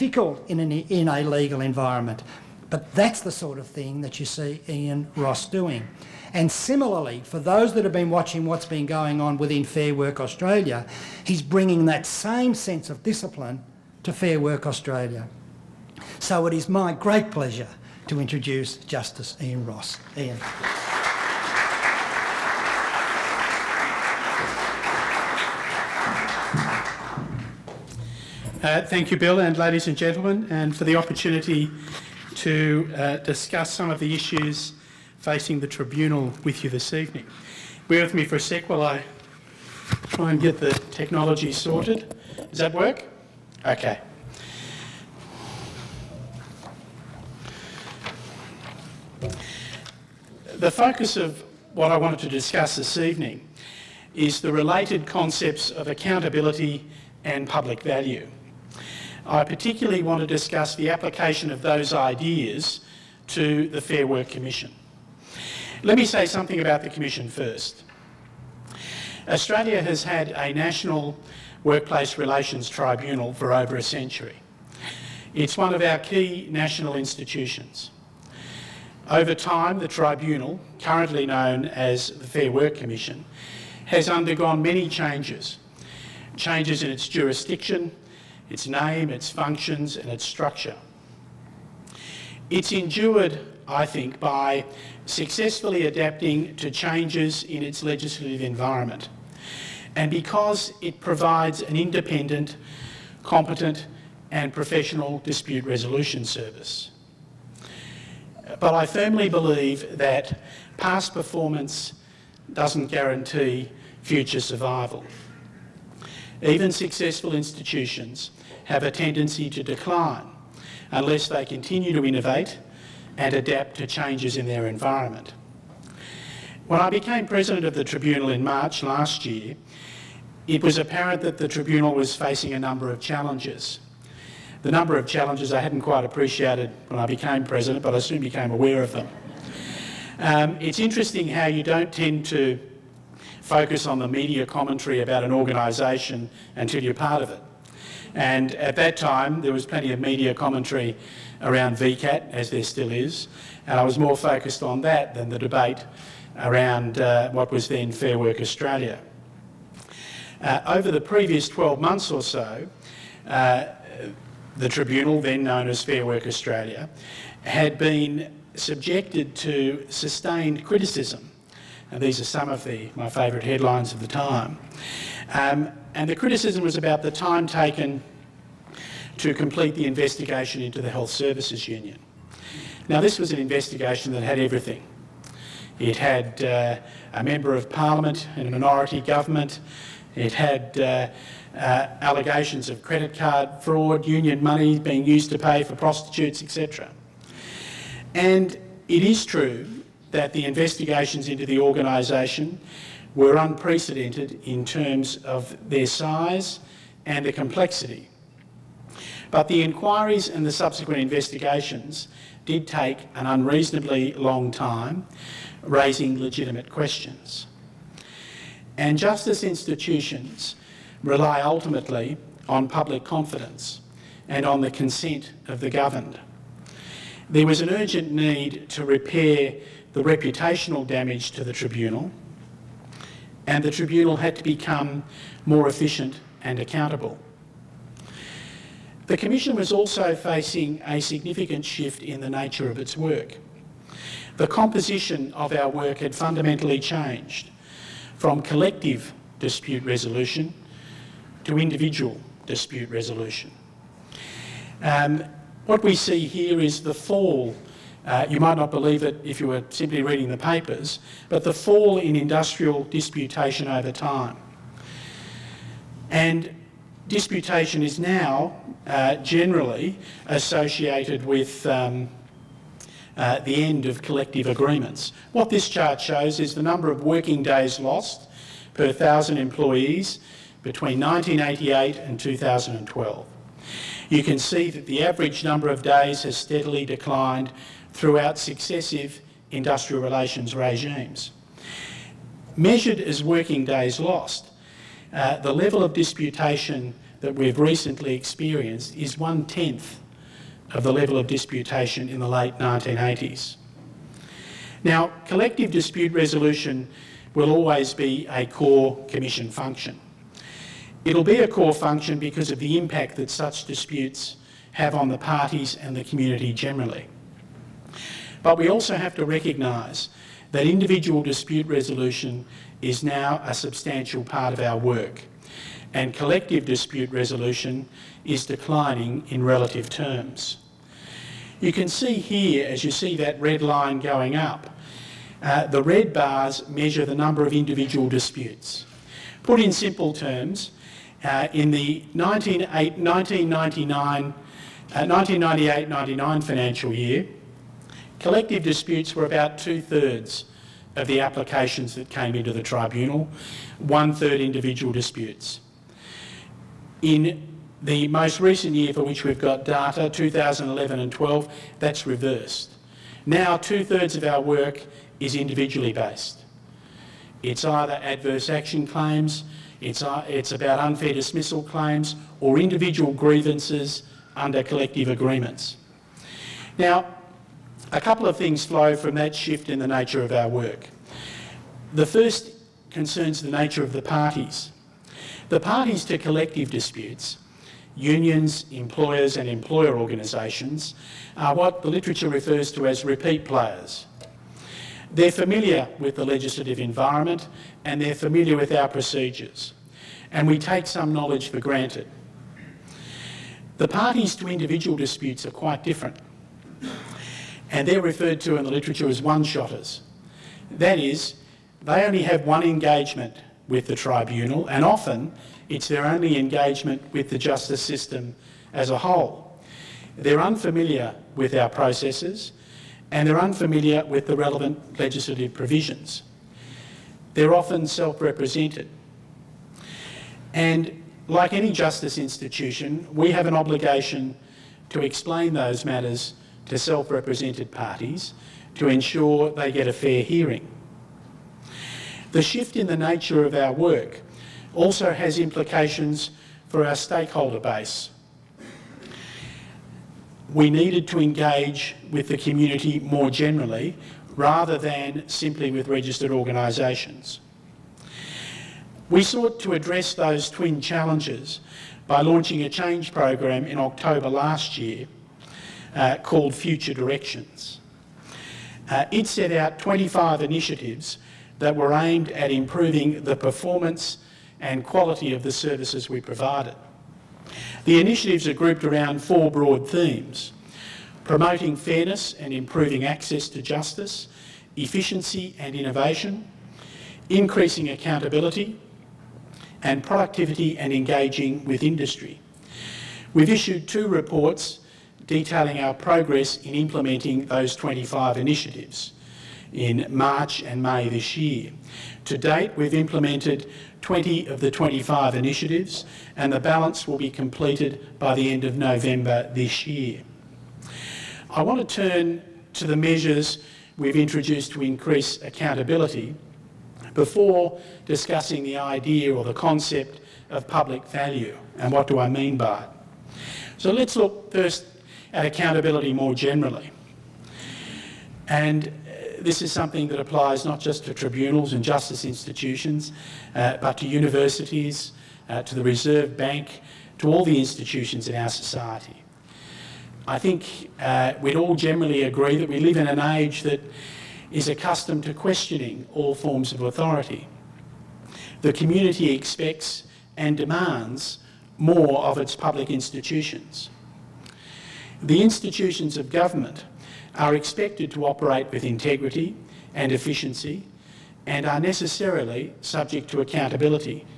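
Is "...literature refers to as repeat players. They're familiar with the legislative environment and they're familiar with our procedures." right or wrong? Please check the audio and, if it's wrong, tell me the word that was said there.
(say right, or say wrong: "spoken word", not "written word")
right.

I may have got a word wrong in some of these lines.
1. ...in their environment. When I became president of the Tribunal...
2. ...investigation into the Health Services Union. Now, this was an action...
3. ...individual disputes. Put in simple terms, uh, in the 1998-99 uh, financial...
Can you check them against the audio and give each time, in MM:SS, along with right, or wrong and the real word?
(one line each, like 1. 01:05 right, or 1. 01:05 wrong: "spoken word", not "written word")
1. 02:04 right
2. 02:59 wrong: "investigation", not "action"
3. 05:37 right.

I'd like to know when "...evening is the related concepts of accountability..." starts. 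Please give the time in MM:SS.
00:52.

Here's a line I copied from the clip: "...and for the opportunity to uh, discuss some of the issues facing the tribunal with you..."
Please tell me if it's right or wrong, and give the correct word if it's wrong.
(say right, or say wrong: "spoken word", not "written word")
right.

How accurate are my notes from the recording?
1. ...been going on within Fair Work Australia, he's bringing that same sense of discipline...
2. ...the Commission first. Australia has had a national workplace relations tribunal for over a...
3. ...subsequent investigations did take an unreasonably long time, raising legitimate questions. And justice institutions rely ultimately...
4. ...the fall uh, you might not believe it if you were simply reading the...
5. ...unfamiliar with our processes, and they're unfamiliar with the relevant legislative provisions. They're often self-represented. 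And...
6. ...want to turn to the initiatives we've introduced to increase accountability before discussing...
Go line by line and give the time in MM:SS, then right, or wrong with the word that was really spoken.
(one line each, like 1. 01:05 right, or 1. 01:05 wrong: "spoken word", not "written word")
1. 00:08 right
2. 01:06 right
3. 03:30 right
4. 04:16 right
5. 07:00 right
6. 08:31 wrong: "measures", not "initiatives".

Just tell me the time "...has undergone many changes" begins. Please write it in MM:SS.
01:23.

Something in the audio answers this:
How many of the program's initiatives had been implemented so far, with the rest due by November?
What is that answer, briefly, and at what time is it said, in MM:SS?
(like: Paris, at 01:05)
20, at 08:24.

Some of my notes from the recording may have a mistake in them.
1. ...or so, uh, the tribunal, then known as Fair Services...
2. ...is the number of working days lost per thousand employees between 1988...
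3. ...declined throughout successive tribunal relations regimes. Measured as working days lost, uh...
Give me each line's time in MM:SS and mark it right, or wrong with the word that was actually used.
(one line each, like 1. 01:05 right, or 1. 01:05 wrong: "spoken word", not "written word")
1. 02:42 wrong: "Work", not "Services"
2. 04:36 right
3. 04:46 wrong: "industrial", not "tribunal".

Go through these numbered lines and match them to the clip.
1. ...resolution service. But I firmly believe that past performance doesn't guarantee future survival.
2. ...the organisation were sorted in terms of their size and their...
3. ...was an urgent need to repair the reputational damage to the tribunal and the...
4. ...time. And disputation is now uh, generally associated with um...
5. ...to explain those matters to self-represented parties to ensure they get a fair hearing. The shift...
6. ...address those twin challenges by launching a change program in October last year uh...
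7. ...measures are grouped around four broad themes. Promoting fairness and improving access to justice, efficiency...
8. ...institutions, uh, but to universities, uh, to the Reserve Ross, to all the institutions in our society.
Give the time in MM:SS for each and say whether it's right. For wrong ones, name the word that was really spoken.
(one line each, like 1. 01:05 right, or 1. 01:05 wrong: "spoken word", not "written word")
1. 01:45 right
2. 03:21 wrong: "unprecedented", not "sorted"
3. 03:47 right
4. 04:23 right
5. 07:14 right
6. 07:39 right
7. 07:57 wrong: "initiatives", not "measures"
8. 08:52 wrong: "Bank", not "Ross".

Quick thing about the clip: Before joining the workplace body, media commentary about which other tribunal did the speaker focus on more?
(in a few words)
VCAT.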